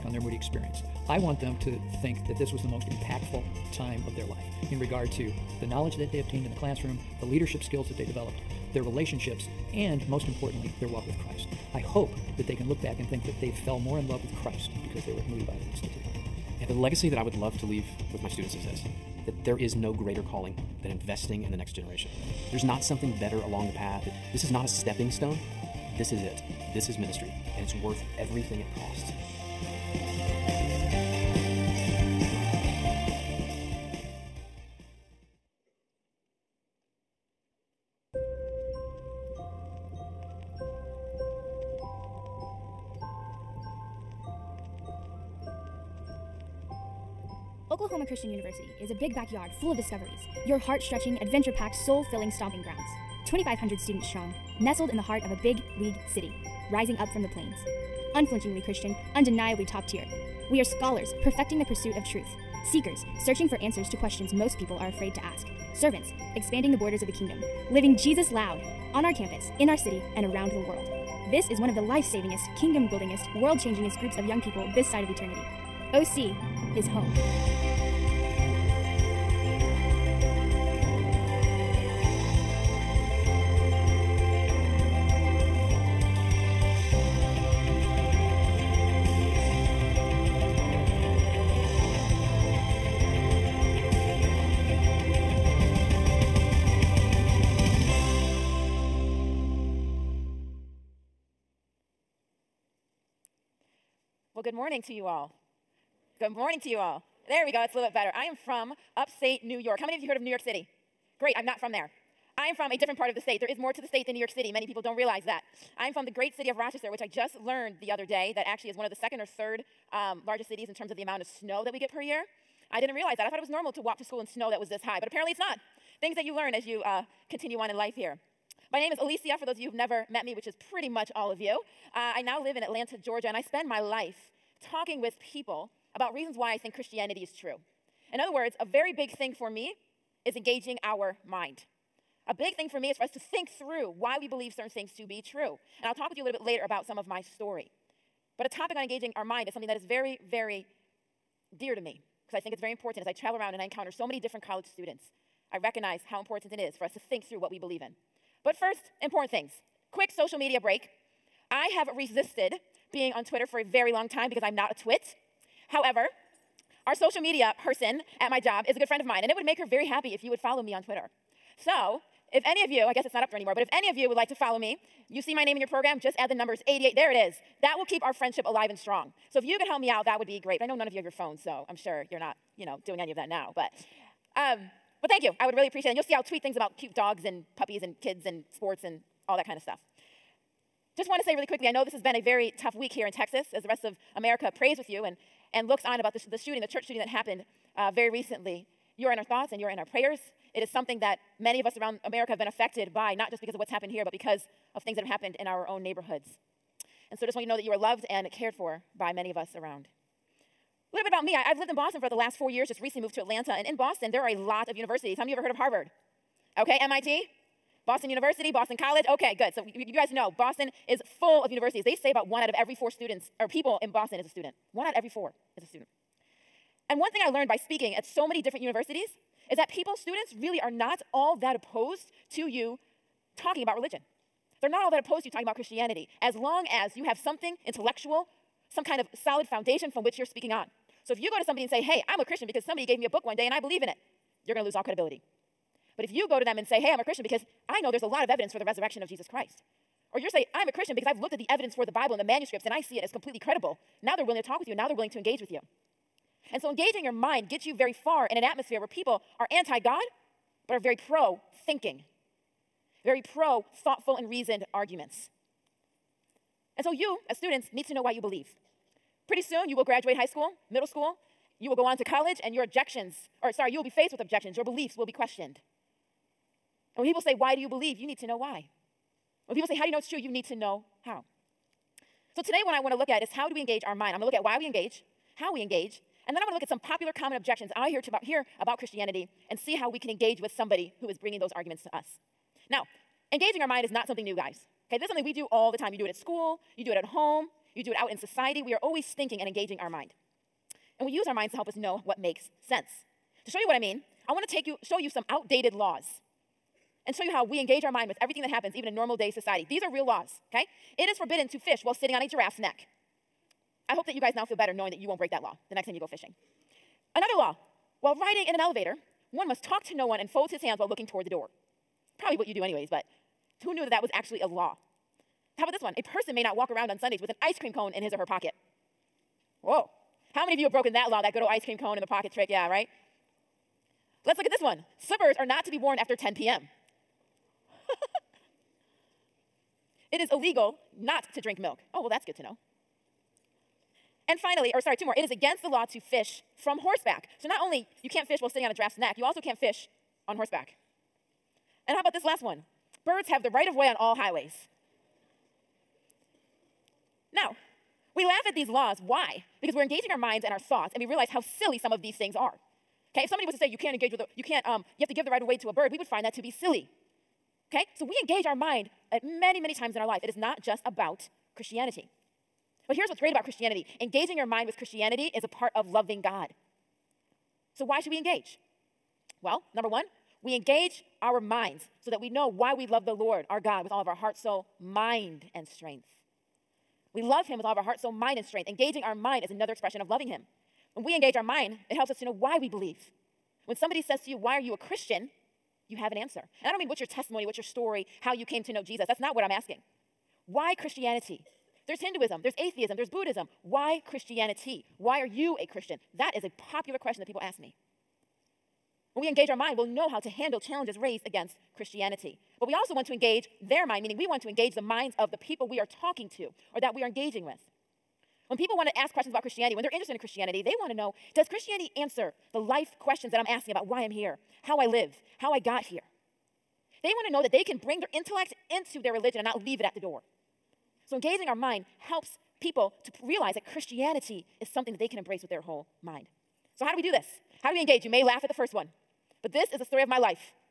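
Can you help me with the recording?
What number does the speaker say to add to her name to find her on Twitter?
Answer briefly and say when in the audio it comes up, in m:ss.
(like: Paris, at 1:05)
88, at 2:56.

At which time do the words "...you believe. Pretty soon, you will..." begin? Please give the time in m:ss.
4:28.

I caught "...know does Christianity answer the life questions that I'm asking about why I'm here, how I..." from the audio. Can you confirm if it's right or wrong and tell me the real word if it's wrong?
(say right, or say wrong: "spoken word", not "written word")
right.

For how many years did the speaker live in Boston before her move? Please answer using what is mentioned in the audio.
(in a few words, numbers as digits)
4.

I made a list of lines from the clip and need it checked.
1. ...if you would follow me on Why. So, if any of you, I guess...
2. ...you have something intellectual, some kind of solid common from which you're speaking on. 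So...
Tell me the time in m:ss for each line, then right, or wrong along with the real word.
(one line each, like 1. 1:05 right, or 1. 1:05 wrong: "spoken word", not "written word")
1. 2:50 wrong: "Twitter", not "Why"
2. 3:56 wrong: "foundation", not "common".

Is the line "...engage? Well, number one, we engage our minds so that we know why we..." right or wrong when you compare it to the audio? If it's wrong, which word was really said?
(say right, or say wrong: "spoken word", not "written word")
right.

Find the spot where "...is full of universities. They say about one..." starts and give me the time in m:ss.
3:40.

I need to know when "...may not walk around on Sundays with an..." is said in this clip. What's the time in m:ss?
5:26.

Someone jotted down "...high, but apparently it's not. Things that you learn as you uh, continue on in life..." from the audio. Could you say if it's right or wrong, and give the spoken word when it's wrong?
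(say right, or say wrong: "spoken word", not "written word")
right.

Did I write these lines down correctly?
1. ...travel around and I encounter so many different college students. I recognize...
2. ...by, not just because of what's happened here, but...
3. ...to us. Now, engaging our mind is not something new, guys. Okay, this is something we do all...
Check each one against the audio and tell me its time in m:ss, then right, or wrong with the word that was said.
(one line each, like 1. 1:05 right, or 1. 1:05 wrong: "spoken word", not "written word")
1. 2:33 right
2. 3:22 right
3. 4:51 right.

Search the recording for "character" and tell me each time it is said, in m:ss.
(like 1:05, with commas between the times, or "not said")
not said.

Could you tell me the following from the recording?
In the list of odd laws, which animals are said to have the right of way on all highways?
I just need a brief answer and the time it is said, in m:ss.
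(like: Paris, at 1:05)
Birds, at 5:53.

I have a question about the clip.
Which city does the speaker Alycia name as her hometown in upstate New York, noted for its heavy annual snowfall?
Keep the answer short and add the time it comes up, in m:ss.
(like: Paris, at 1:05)
Rochester, at 1:56.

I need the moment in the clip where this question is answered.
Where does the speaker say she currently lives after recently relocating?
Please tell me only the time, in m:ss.
2:12.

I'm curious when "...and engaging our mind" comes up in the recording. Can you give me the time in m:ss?
4:59.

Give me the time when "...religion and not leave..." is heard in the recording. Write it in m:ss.
7:09.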